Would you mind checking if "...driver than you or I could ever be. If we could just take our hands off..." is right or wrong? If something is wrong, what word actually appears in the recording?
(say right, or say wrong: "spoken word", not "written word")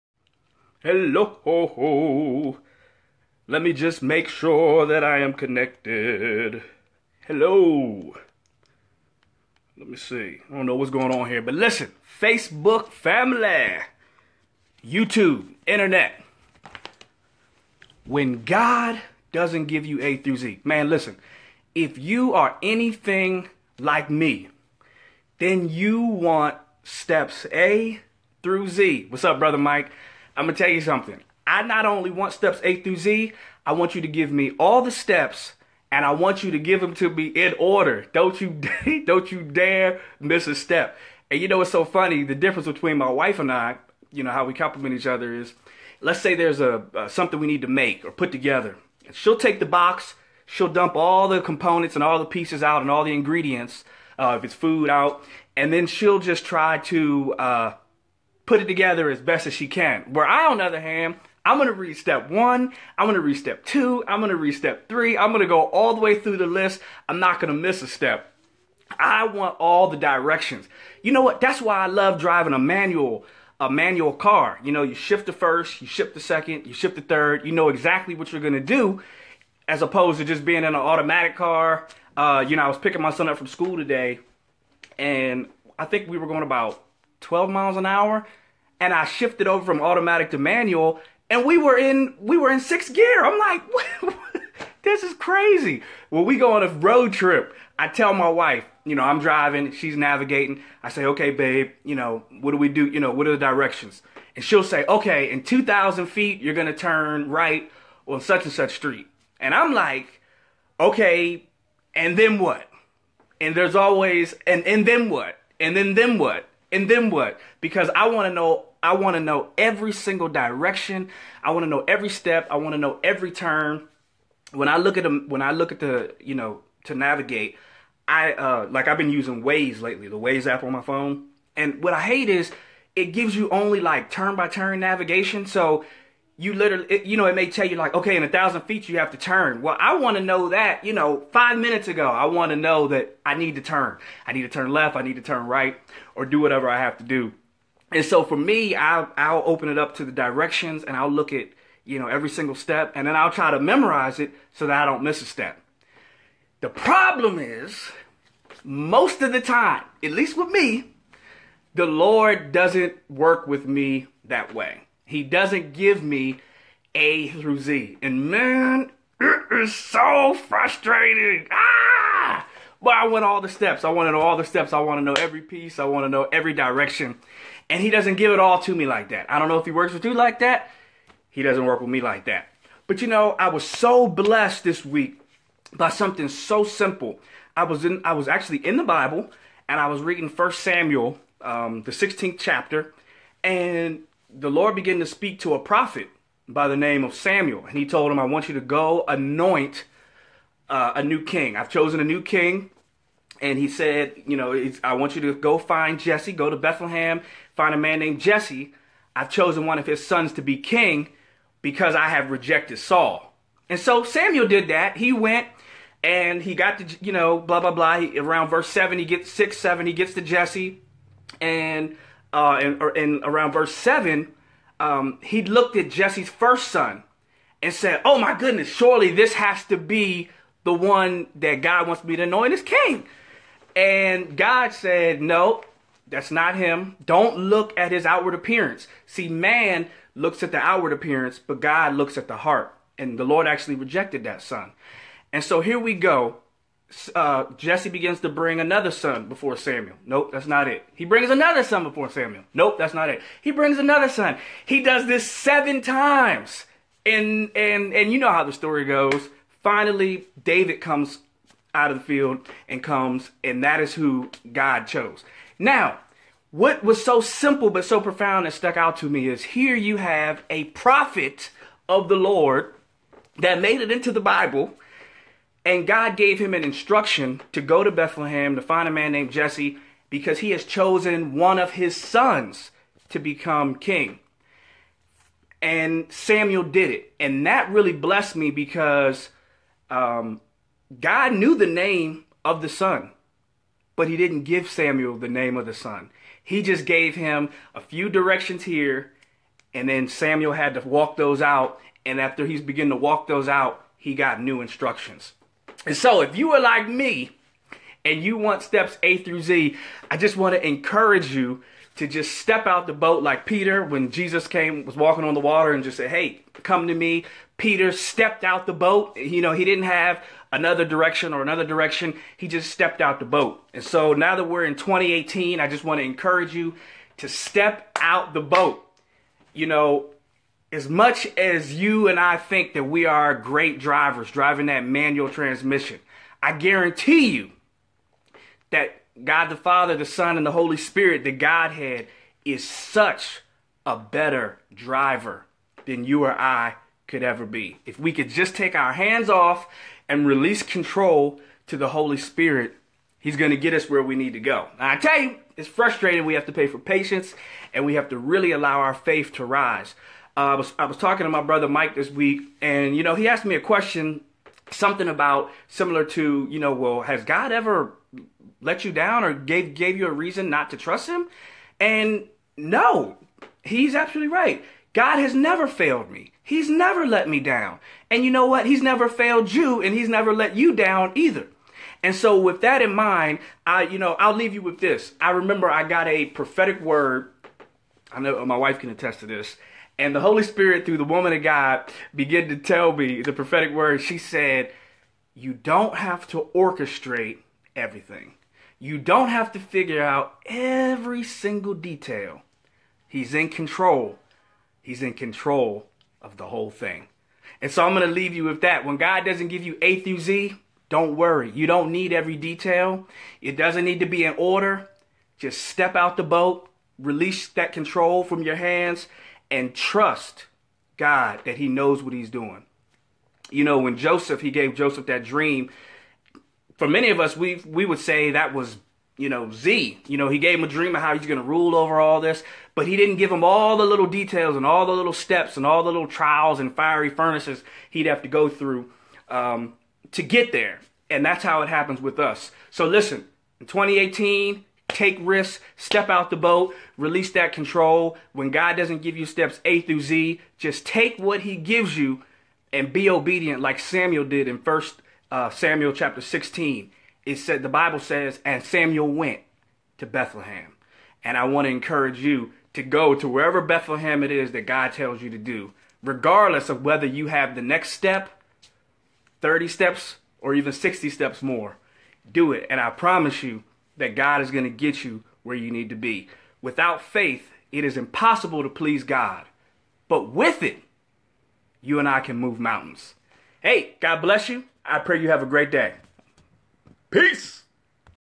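right.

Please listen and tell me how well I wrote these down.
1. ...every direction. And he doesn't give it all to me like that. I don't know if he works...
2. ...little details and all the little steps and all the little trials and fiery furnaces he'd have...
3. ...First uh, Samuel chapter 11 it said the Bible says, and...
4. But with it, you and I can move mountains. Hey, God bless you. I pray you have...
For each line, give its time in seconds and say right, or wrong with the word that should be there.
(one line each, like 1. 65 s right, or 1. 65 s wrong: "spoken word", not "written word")
1. 176 s right
2. 433 s right
3. 454 s wrong: "16", not "11"
4. 480 s right.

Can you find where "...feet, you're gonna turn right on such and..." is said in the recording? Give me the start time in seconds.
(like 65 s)
106 s.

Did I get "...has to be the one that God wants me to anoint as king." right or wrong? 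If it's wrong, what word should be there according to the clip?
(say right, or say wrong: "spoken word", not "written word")
right.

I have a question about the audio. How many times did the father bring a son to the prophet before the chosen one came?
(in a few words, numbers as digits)
7.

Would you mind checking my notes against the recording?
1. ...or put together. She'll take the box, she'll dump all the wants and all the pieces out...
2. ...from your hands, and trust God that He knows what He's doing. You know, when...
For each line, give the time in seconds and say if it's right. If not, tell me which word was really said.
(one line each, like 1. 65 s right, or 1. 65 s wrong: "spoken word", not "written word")
1. 48 s wrong: "components", not "wants"
2. 418 s right.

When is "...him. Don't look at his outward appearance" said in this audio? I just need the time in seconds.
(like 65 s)
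236 s.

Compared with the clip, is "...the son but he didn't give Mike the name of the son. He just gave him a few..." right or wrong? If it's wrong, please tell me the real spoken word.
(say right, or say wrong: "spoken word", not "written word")
wrong: "Samuel", not "Mike".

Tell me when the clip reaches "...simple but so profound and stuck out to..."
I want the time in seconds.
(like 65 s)
267 s.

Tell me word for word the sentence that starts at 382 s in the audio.
And so with that in mind, I you know, I'll leave you with this.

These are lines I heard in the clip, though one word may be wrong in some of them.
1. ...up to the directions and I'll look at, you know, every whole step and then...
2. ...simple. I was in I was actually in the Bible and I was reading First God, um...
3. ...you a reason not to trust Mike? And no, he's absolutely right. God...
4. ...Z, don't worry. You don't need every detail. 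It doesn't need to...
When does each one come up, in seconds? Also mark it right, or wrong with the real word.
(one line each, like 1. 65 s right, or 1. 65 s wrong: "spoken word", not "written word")
1. 149 s wrong: "single", not "whole"
2. 186 s wrong: "Samuel", not "God"
3. 369 s wrong: "Him", not "Mike"
4. 410 s right.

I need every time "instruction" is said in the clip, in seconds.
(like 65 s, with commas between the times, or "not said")
276 s, 304 s.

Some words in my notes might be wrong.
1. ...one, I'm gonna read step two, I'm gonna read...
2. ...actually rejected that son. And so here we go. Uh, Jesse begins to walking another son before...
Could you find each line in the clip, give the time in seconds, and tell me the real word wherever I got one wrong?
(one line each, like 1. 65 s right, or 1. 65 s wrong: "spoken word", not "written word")
1. 62 s right
2. 243 s wrong: "bring", not "walking".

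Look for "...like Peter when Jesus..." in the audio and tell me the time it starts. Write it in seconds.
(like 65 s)
313 s.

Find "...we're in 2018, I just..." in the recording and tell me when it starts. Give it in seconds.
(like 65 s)
324 s.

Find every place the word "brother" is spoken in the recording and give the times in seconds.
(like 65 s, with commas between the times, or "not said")
29 s, 361 s.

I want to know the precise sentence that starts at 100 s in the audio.
I say, okay, babe, you know, what do we do?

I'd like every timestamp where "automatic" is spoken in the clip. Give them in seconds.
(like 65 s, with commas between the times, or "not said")
80 s, 89 s.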